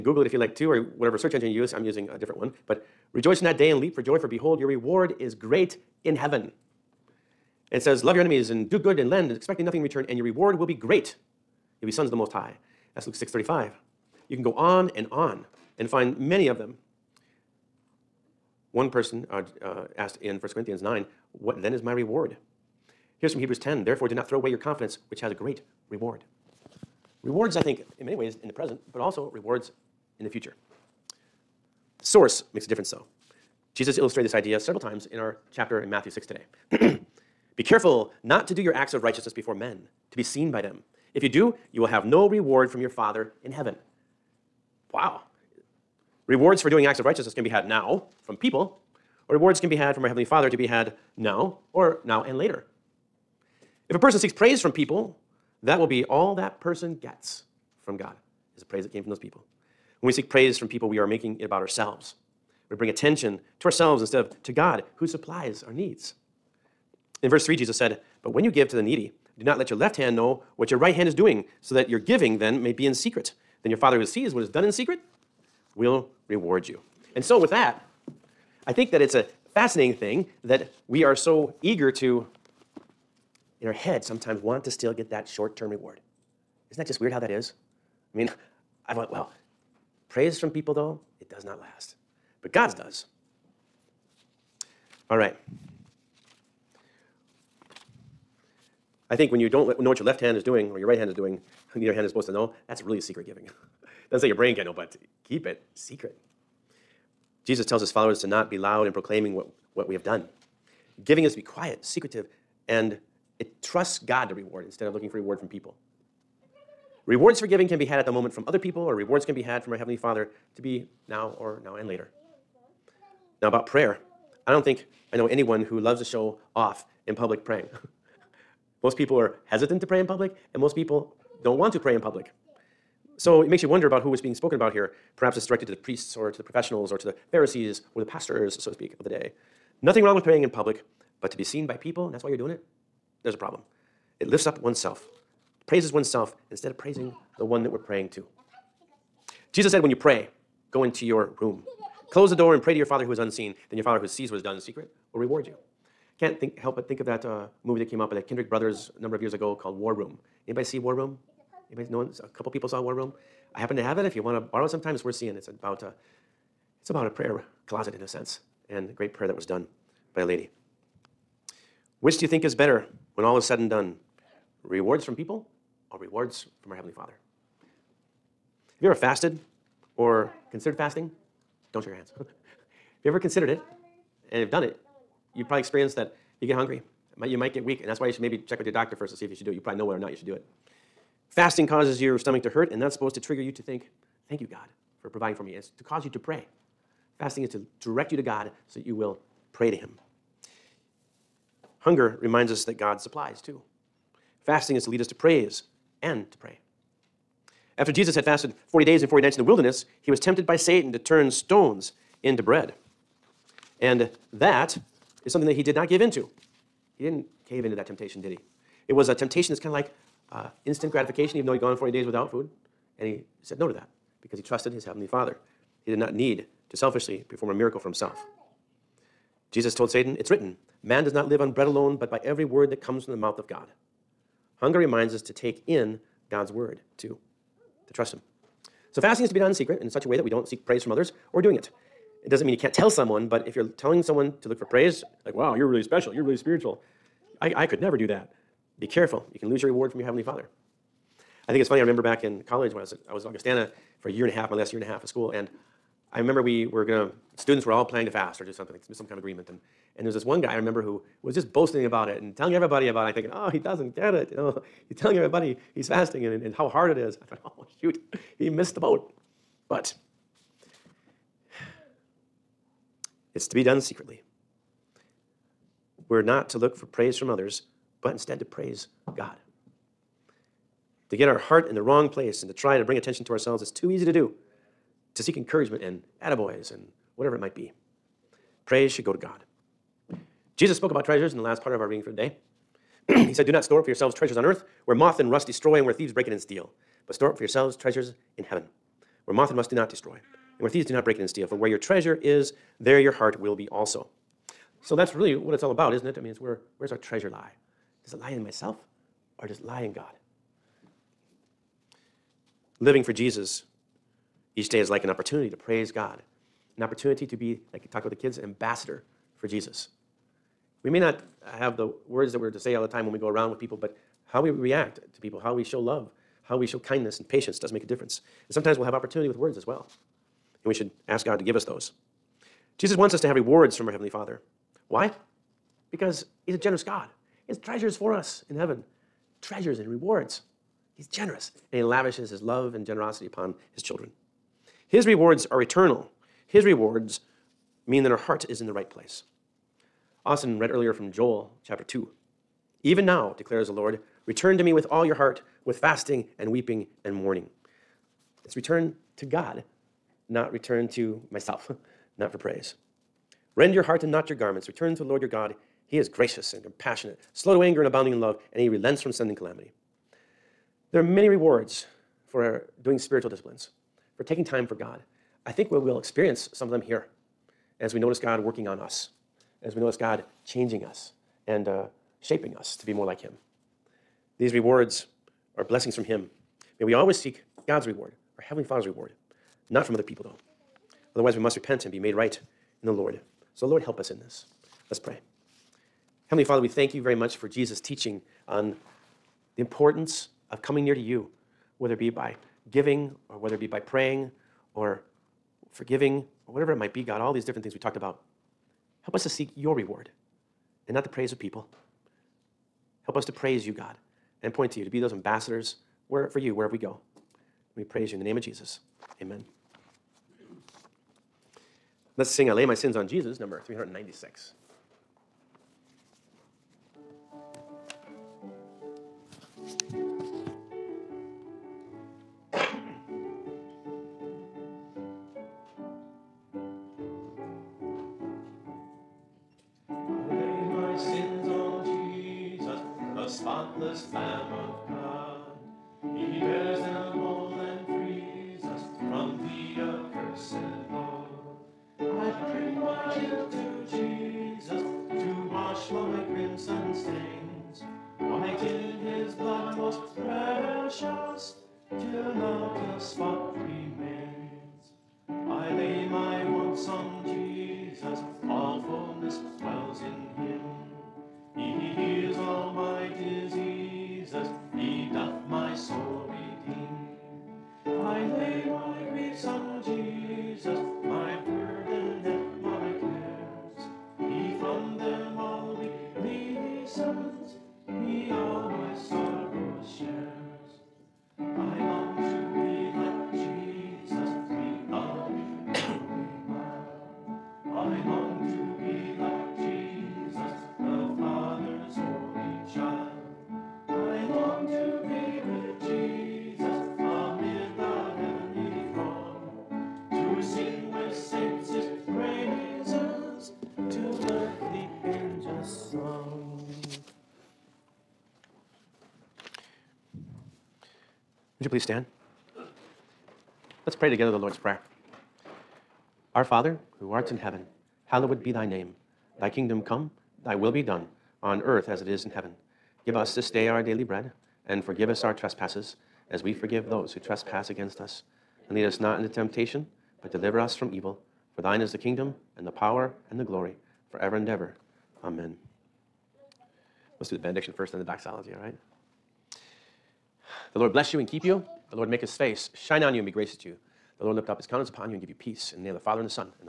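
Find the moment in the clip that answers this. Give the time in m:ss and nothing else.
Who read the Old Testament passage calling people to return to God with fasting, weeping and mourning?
5:50.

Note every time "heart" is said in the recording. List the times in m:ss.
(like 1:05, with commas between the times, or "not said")
4:41, 5:03, 5:48, 5:55, 6:03.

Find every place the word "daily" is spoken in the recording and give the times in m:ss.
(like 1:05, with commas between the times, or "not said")
8:53.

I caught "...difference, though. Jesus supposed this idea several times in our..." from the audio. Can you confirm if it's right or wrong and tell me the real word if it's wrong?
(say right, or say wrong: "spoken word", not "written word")
wrong: "illustrated", not "supposed".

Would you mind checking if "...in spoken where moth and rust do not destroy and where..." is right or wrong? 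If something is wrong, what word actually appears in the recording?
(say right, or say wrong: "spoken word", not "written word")
wrong: "heaven", not "spoken".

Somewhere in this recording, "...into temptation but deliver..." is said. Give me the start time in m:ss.
8:59.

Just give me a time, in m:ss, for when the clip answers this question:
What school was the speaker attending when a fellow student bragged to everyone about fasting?
4:13.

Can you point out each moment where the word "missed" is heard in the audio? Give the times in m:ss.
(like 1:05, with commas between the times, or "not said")
4:28.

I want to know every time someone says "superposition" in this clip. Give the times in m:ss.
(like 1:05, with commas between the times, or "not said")
not said.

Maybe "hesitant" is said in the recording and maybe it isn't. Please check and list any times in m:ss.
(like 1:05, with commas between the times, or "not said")
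2:09.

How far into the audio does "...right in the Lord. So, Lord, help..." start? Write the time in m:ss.
6:32.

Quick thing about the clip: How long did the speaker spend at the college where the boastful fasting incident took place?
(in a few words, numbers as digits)
A year and a half.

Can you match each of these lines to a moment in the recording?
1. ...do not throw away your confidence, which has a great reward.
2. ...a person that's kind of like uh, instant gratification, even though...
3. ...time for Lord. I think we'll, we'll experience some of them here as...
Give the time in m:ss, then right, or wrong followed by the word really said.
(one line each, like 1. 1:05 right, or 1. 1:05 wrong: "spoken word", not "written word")
1. 0:24 right
2. 3:39 wrong: "temptation", not "person"
3. 6:14 wrong: "God", not "Lord".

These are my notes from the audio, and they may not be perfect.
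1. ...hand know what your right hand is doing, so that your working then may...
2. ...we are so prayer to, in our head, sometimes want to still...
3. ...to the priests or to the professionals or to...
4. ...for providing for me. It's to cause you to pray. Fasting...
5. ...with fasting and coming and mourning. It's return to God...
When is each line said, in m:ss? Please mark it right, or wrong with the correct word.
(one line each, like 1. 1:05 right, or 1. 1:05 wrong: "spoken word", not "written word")
1. 1:09 wrong: "giving", not "working"
2. 1:20 wrong: "eager", not "prayer"
3. 2:15 right
4. 3:15 right
5. 5:55 wrong: "weeping", not "coming".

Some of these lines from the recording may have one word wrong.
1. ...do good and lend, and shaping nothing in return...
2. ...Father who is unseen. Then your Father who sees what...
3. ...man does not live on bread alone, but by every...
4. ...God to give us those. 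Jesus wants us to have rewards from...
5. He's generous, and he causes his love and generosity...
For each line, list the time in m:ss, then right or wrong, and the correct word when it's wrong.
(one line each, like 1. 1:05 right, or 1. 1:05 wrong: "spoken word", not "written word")
1. 0:08 wrong: "expecting", not "shaping"
2. 2:32 right
3. 3:50 right
4. 5:31 right
5. 5:40 wrong: "lavishes", not "causes".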